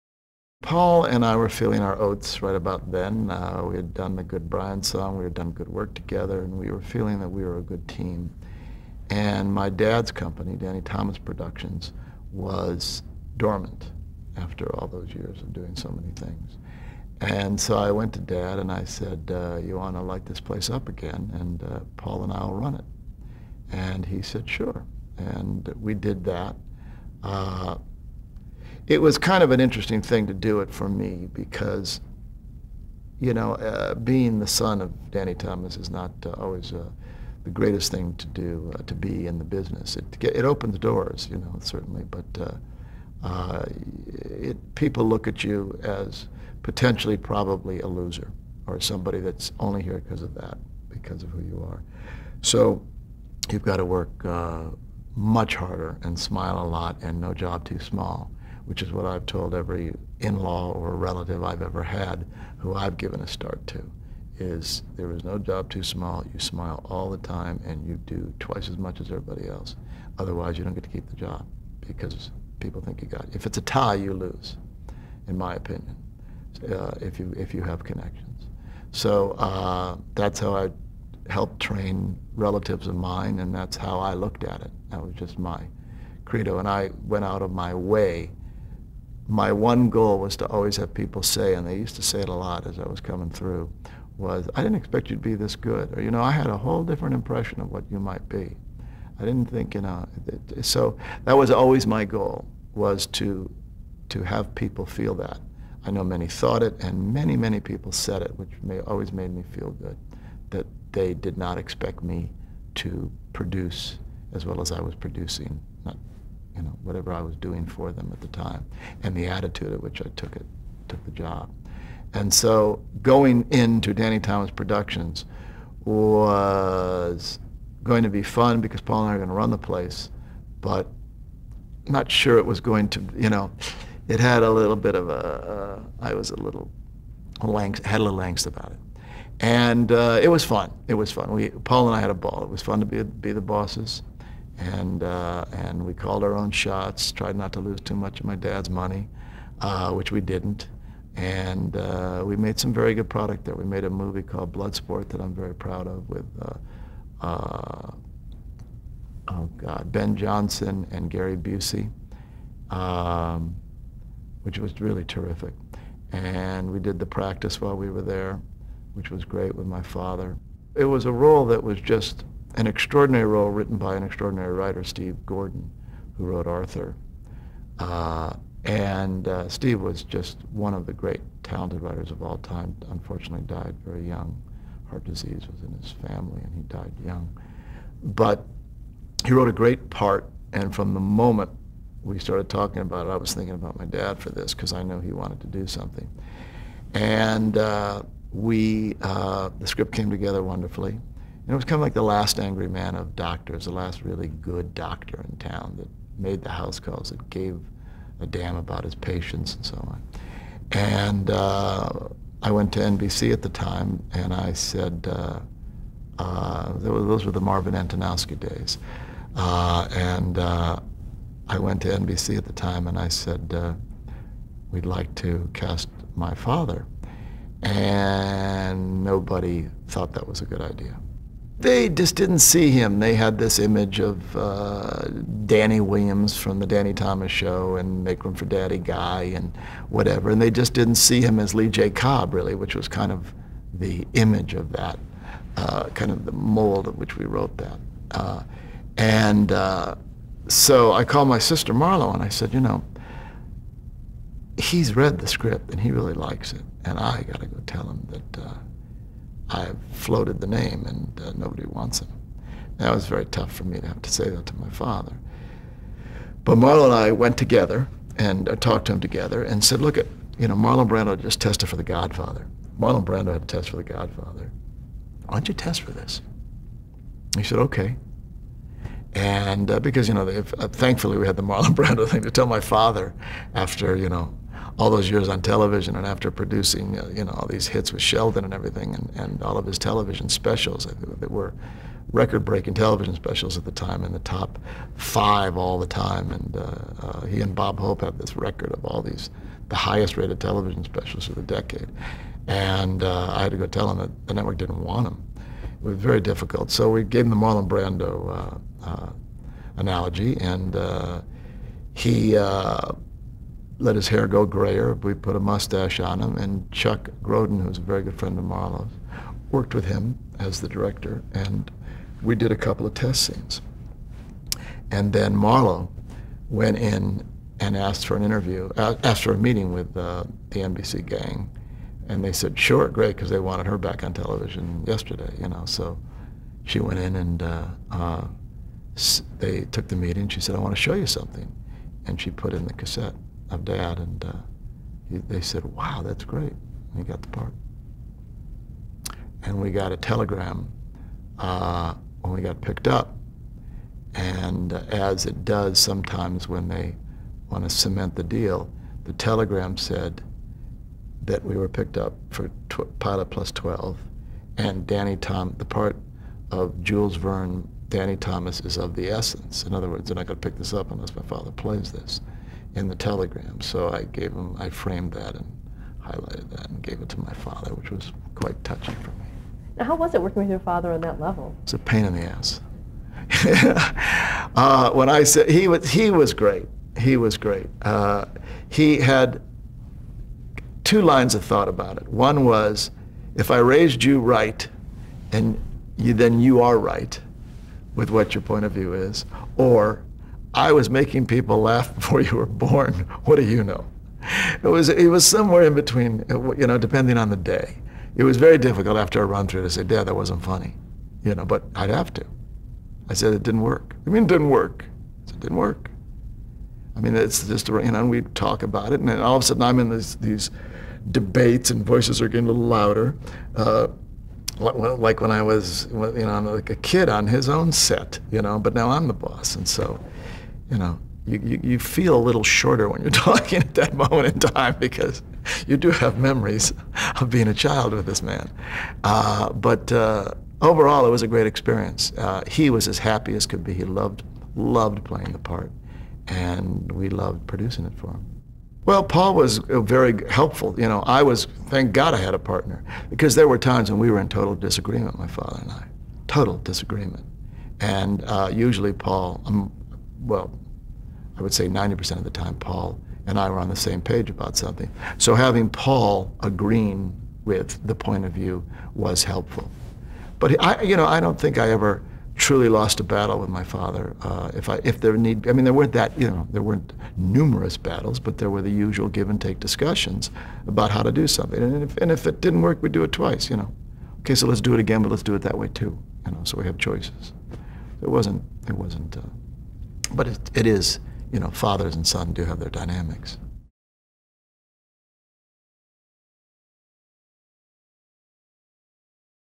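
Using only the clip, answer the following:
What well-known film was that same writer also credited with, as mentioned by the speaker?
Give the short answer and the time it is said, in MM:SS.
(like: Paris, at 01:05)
Arthur, at 02:56.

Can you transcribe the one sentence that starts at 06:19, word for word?
Now, how was it working with your father on that level?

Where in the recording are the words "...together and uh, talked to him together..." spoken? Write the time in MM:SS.
04:27.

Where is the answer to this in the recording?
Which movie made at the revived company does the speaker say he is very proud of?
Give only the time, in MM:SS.
02:34.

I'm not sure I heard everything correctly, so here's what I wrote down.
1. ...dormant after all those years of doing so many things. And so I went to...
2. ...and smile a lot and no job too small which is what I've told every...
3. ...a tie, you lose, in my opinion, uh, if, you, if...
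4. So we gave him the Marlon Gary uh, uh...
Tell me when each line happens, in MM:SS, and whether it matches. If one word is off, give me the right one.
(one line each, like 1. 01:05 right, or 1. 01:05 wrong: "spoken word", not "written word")
1. 00:13 right
2. 00:56 right
3. 01:13 right
4. 05:06 wrong: "Brando", not "Gary".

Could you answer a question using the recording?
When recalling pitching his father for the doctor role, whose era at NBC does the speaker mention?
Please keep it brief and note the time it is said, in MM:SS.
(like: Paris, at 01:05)
Marvin Antonowsky, at 03:37.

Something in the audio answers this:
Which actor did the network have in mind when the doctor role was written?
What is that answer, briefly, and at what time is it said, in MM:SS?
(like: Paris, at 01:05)
Lee J. Cobb, at 04:01.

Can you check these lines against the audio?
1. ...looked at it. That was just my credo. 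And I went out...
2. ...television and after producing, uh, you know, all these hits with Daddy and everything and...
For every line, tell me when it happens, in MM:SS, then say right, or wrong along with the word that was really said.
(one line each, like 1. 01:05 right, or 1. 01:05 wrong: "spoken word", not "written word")
1. 01:24 right
2. 04:45 wrong: "Sheldon", not "Daddy".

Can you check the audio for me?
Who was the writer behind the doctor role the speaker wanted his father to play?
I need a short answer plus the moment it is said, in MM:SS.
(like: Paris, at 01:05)
Steve Gordon, at 02:54.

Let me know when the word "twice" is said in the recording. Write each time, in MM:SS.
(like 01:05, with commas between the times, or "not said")
01:08, 08:03.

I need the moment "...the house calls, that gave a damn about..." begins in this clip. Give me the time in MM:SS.
03:26.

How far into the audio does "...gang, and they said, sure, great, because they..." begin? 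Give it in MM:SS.
05:31.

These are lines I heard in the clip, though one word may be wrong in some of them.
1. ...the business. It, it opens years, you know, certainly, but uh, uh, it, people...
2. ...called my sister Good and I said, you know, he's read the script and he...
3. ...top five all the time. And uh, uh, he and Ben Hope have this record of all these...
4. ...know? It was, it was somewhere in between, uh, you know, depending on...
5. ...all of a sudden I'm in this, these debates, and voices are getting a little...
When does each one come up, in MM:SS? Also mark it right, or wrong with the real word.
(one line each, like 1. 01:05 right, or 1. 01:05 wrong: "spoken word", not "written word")
1. 00:39 wrong: "doors", not "years"
2. 04:11 wrong: "Marlo", not "Good"
3. 04:54 wrong: "Bob", not "Ben"
4. 06:43 right
5. 06:59 right.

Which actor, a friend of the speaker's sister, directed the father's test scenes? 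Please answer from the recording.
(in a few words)
Chuck Grodin.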